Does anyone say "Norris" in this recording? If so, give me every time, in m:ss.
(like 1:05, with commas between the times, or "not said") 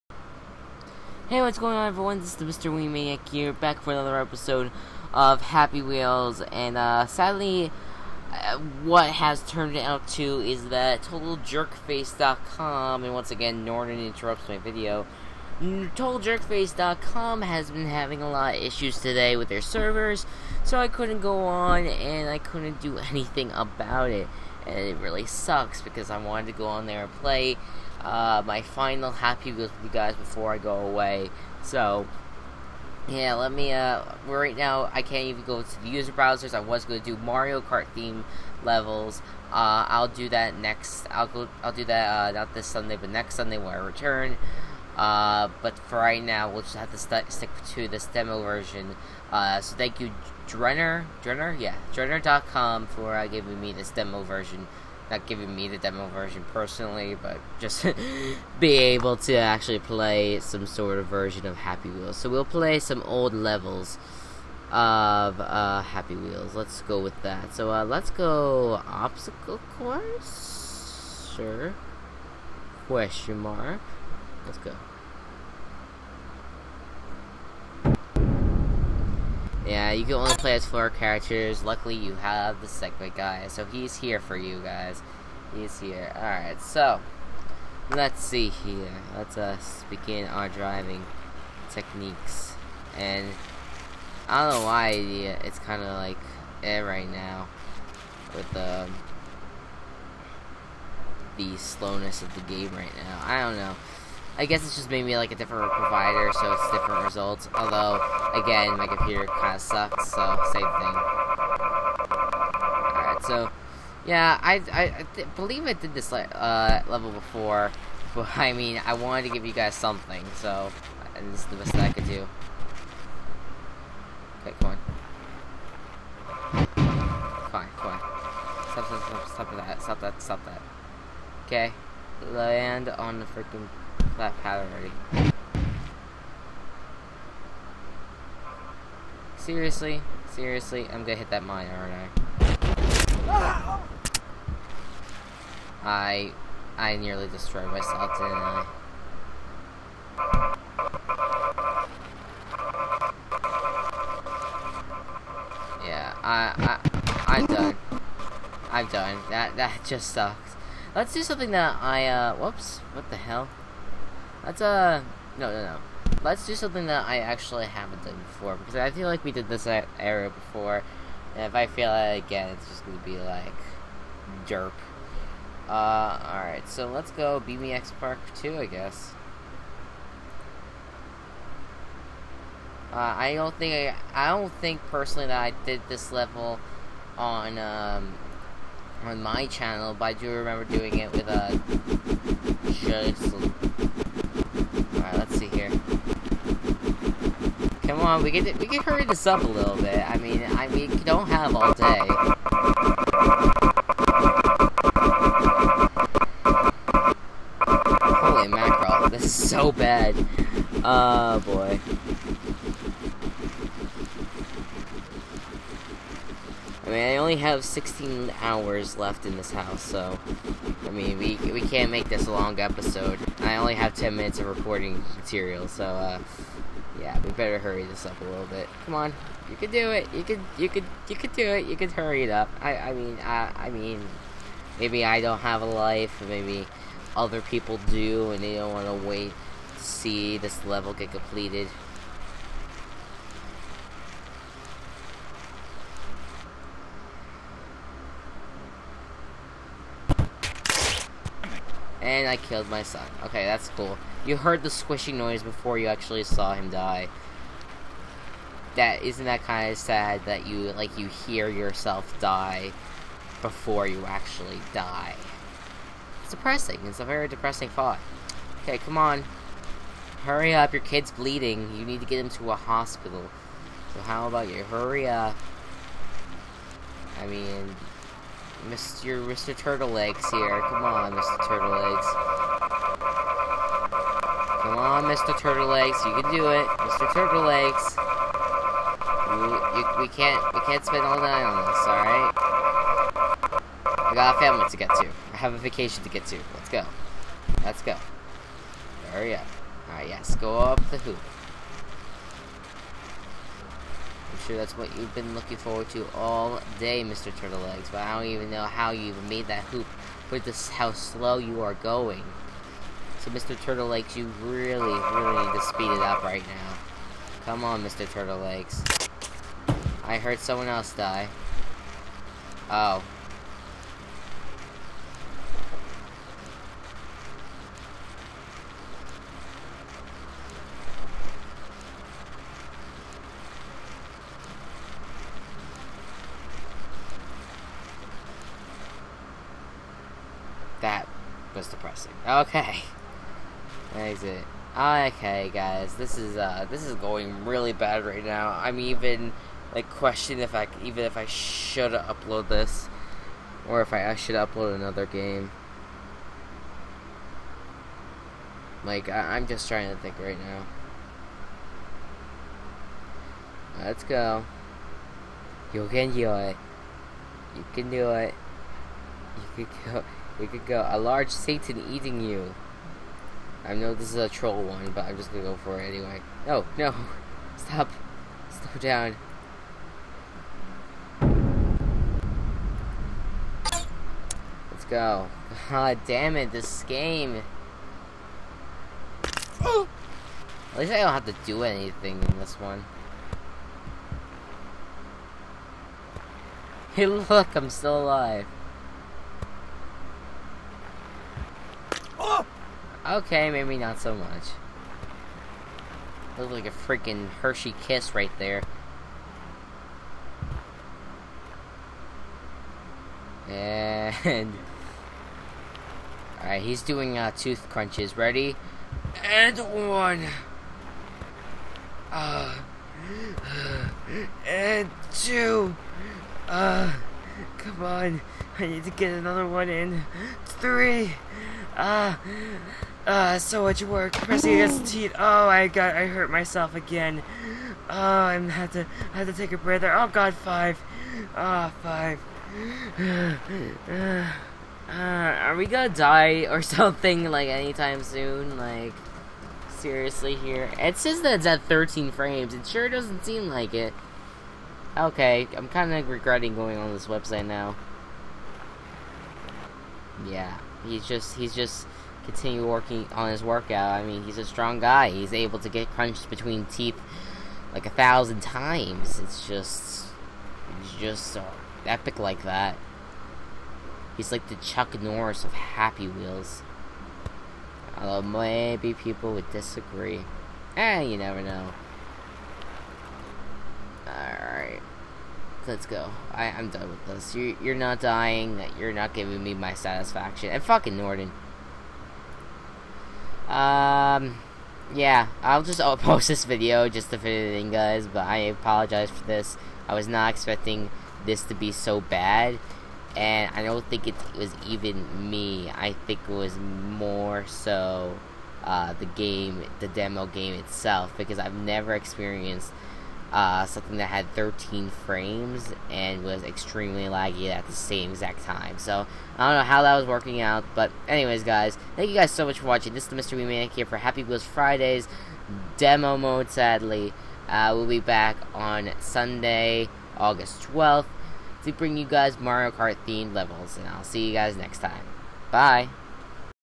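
7:55.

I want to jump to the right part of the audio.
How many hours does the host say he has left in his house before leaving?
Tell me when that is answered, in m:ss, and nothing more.
3:37.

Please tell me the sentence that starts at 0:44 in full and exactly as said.
Uh, but for right now, we'll just have to st stick to this demo version.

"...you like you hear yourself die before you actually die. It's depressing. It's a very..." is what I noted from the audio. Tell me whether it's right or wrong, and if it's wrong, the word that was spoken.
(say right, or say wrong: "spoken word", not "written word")
right.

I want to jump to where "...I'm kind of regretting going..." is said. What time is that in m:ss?
7:35.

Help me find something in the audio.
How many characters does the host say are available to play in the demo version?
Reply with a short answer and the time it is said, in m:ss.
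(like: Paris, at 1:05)
4, at 1:20.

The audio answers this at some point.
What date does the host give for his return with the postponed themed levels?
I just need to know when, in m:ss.
8:50.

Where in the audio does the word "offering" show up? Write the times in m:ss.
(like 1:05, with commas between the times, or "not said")
not said.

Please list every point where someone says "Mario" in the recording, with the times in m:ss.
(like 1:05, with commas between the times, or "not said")
0:37, 8:52.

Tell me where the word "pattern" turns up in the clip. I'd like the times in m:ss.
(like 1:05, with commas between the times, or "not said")
2:14.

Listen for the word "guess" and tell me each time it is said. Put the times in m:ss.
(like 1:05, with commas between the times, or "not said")
1:44, 2:58.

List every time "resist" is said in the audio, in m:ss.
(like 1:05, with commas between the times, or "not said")
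not said.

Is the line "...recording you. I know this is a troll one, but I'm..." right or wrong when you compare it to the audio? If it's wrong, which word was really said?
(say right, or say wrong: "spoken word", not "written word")
wrong: "eating", not "recording".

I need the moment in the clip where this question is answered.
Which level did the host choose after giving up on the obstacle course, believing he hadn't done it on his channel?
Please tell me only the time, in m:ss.
2:57.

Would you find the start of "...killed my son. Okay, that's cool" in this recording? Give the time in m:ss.
4:12.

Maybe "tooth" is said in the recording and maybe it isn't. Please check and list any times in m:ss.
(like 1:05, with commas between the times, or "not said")
6:57.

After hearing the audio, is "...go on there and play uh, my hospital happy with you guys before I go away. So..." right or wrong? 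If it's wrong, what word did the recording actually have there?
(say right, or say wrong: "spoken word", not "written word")
wrong: "final", not "hospital".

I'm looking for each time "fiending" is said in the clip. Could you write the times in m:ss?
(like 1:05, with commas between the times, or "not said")
not said.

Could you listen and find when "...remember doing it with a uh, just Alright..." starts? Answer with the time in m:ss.
3:10.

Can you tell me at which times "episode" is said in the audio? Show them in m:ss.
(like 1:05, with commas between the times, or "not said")
0:04, 3:42.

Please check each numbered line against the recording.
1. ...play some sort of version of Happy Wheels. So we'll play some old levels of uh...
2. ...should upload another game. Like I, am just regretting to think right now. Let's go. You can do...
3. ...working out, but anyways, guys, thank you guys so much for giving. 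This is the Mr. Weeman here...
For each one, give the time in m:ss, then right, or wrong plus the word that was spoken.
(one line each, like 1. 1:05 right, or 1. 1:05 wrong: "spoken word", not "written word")
1. 0:59 right
2. 5:54 wrong: "trying", not "regretting"
3. 8:40 wrong: "watching", not "giving".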